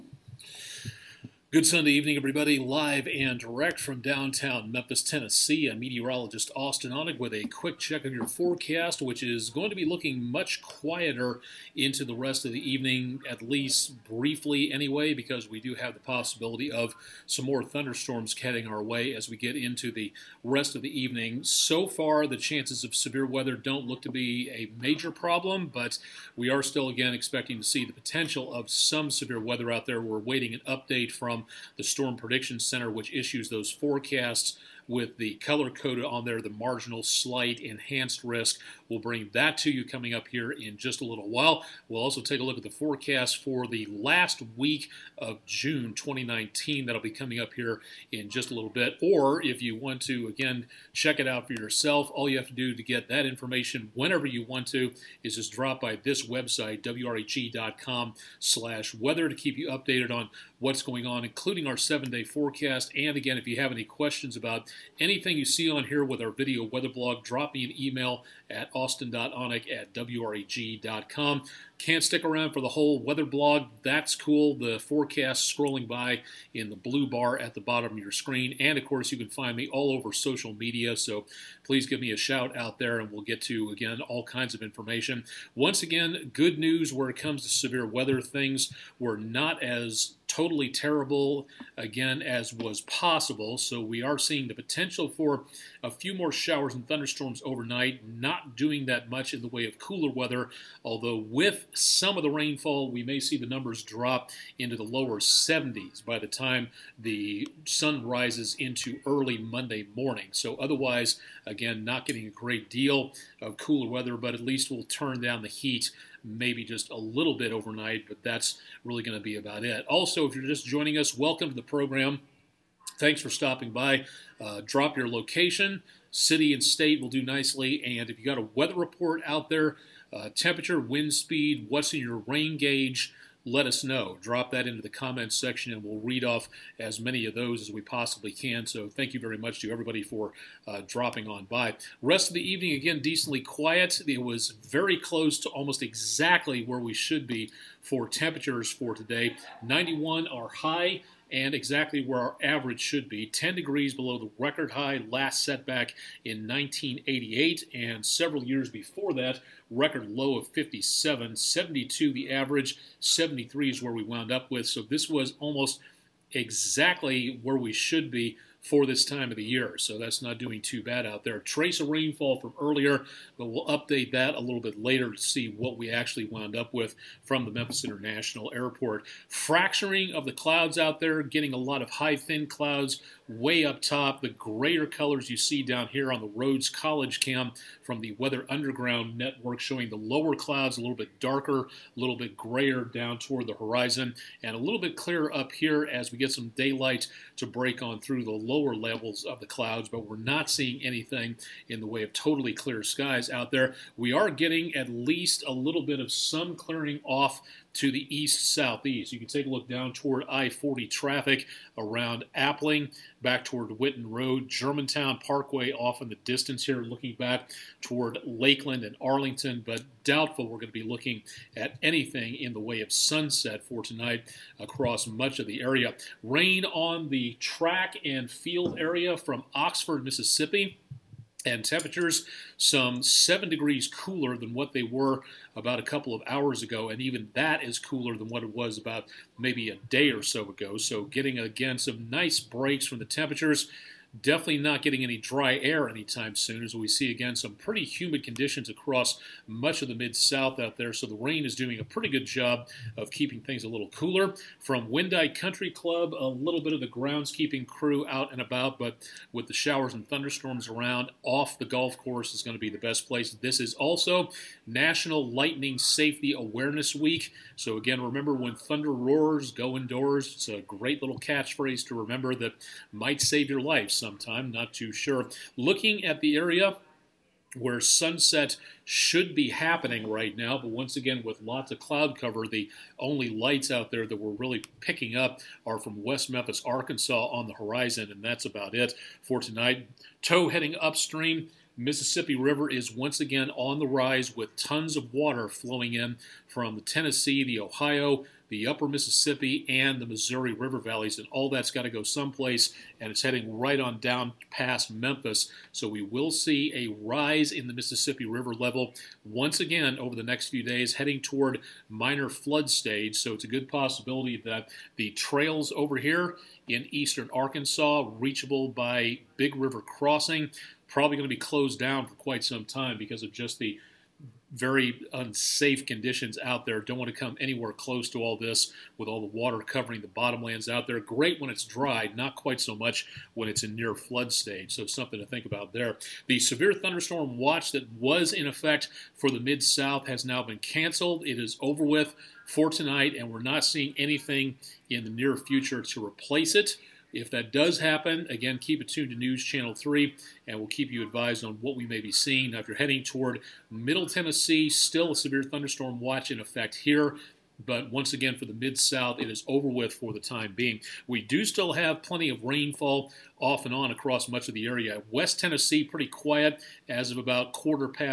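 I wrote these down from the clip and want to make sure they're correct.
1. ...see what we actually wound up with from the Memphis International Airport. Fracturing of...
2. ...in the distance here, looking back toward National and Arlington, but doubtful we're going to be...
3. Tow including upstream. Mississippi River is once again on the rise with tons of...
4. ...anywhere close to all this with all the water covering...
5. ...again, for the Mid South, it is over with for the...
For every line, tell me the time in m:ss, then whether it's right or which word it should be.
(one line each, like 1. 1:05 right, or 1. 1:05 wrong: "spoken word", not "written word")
1. 2:55 right
2. 3:36 wrong: "Lakeland", not "National"
3. 4:50 wrong: "heading", not "including"
4. 5:27 right
5. 5:58 right.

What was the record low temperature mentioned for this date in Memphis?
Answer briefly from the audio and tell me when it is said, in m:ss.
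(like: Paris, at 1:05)
57, at 2:40.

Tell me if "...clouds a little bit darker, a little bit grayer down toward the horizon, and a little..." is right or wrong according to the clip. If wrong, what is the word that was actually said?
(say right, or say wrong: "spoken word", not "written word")
right.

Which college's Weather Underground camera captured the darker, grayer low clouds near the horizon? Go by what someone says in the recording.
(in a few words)
Rhodes College.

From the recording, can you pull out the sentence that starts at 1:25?
Once again, good news where it comes to severe weather.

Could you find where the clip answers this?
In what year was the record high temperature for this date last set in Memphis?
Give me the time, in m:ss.
2:36.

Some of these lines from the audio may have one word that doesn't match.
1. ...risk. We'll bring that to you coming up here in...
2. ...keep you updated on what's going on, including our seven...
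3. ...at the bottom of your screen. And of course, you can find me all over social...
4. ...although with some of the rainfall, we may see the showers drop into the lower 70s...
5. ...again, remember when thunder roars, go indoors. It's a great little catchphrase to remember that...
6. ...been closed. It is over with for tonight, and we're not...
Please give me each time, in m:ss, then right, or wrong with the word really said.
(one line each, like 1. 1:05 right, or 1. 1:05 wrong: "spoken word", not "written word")
1. 0:38 right
2. 0:59 right
3. 1:17 right
4. 1:40 wrong: "numbers", not "showers"
5. 4:27 right
6. 5:40 wrong: "canceled", not "closed".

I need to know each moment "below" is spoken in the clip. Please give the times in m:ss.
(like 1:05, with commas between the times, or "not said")
2:33.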